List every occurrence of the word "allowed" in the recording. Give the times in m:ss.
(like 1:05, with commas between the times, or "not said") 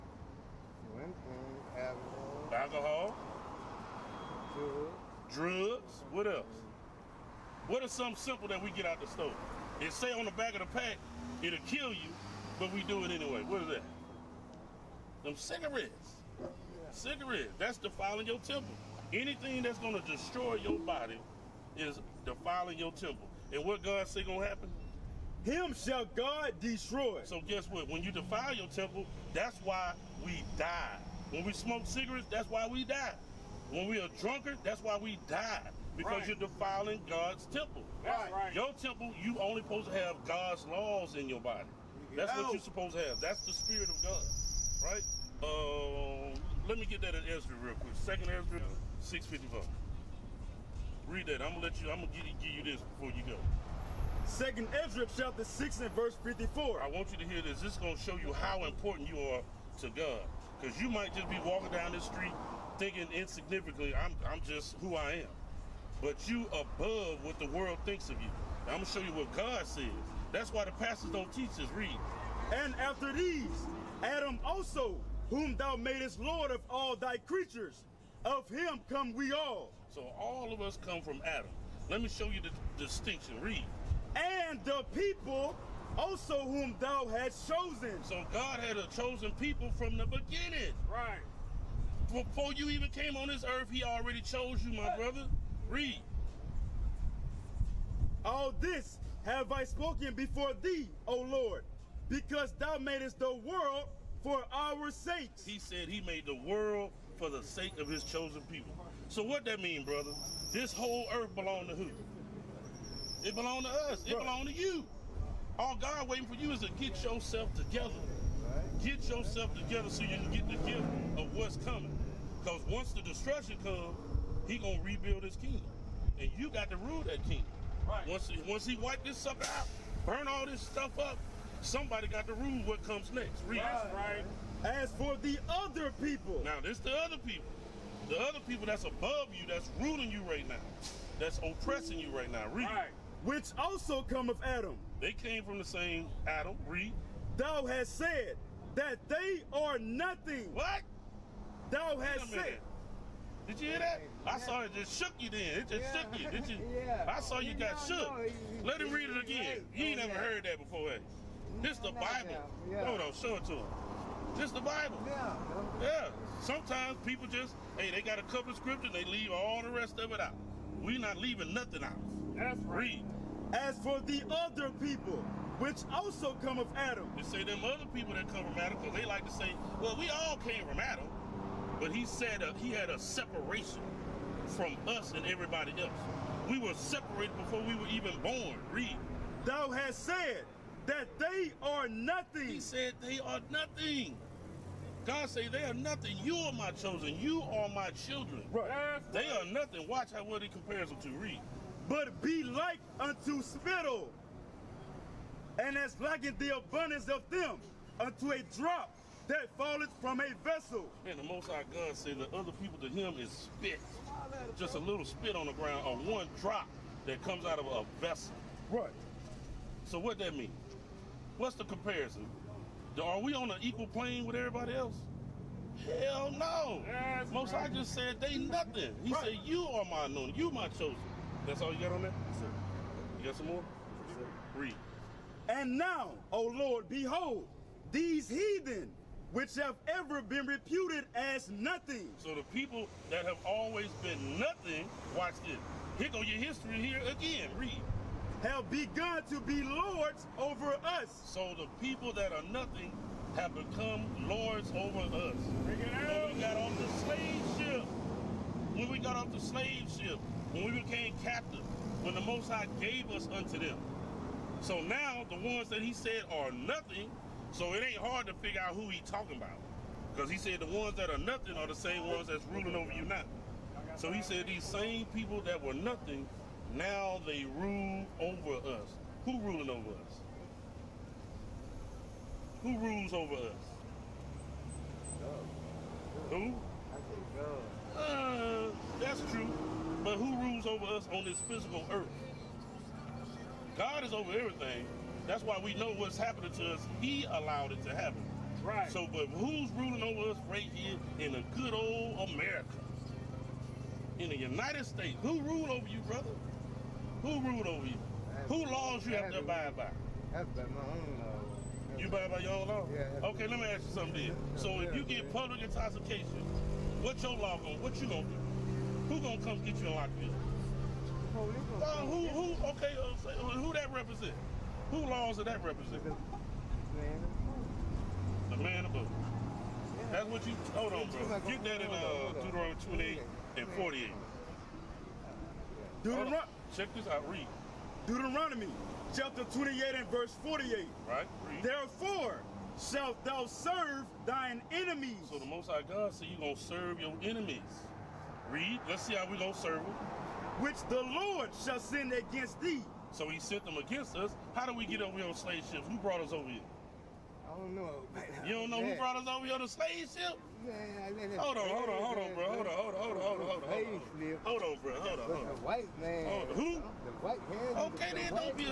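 4:57.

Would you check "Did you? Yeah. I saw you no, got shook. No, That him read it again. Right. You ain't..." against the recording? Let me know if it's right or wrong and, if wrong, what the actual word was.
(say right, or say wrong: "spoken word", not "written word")
wrong: "Let", not "That".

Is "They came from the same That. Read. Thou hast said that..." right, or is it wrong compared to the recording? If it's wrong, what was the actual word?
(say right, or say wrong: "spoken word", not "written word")
wrong: "Adam", not "That".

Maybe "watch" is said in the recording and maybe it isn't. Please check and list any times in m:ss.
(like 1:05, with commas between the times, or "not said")
3:19, 4:05.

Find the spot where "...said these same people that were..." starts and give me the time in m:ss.
4:34.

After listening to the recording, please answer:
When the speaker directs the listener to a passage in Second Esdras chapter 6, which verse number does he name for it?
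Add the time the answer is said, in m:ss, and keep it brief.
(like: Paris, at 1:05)
54, at 0:55.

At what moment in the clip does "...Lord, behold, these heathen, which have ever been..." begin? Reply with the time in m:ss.
3:56.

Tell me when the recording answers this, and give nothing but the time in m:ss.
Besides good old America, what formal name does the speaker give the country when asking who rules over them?
5:04.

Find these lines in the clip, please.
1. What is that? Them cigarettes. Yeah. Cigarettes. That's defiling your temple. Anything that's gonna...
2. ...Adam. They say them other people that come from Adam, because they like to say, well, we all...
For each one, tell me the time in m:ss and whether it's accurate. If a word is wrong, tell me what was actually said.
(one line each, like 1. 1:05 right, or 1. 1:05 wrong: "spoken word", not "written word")
1. 0:13 right
2. 2:56 right.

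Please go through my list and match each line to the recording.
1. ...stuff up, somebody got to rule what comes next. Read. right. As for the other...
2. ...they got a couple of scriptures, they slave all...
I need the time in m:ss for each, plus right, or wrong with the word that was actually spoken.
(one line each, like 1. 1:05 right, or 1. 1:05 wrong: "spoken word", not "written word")
1. 2:10 right
2. 2:47 wrong: "leave", not "slave".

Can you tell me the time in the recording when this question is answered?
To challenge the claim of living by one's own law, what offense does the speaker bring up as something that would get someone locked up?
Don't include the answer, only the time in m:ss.
5:15.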